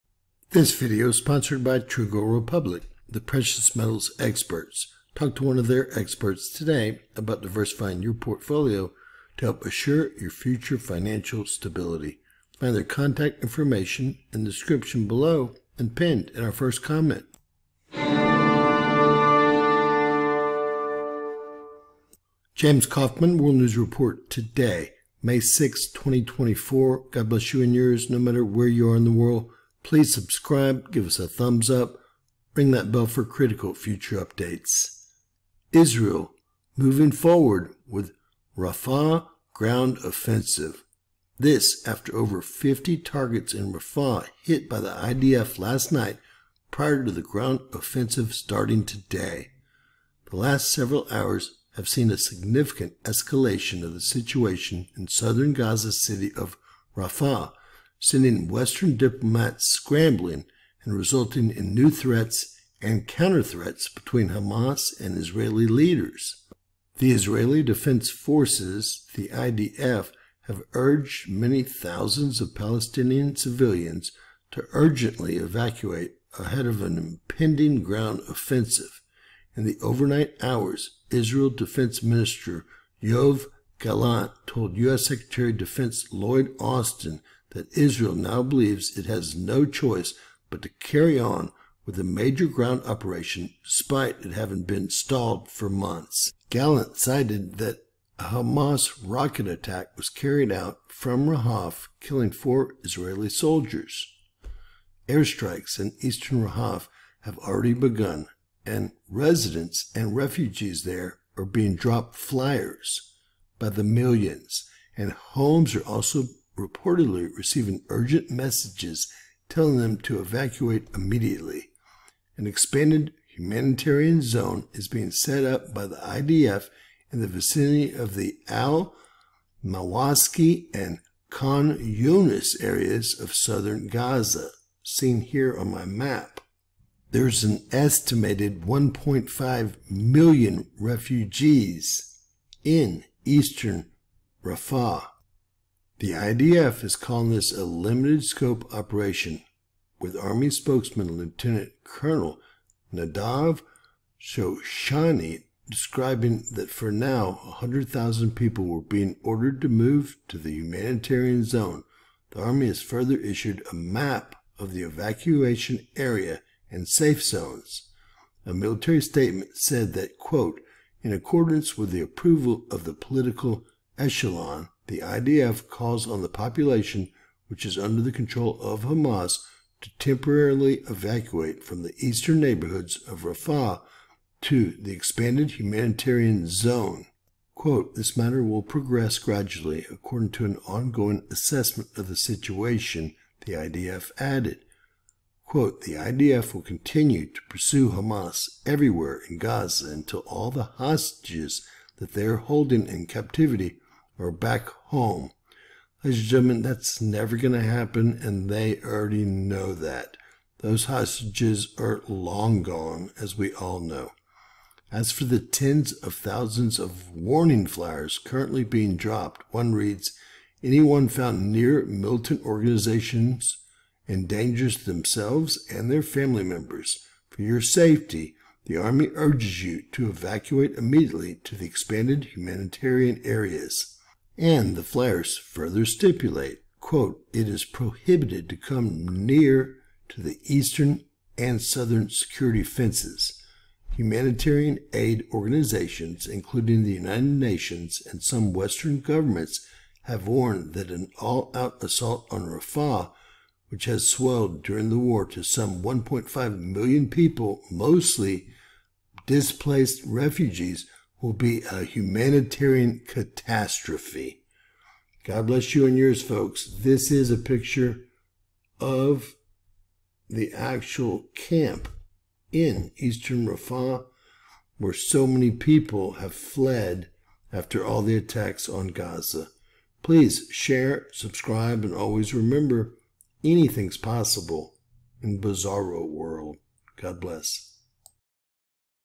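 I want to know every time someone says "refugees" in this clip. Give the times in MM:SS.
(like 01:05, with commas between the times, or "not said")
01:50, 02:20, 04:20.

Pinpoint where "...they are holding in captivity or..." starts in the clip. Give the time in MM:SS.
03:22.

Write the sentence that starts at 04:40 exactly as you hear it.
Please share, subscribe, and always remember anything's possible in Bizarro World.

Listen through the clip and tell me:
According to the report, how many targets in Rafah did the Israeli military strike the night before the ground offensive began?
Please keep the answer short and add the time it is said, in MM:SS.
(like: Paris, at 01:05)
over 50, at 00:42.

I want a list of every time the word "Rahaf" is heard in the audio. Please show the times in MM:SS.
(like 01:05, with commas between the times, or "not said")
01:41, 01:46.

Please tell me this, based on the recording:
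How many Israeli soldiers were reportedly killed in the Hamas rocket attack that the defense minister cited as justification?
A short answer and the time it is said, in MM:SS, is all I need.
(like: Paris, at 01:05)
4, at 01:42.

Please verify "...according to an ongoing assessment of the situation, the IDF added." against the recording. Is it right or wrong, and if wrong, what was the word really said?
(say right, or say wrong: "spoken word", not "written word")
right.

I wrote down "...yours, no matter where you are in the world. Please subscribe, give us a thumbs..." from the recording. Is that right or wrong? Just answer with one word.
right.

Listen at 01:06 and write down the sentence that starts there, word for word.
The Israeli Defense Forces, the IDF, have urged many thousands of Palestinian civilians to urgently evacuate ahead of an impending ground offensive.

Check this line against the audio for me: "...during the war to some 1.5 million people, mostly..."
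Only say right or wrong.
right.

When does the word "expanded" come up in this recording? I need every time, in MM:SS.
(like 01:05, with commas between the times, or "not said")
02:02, 03:04, 03:51.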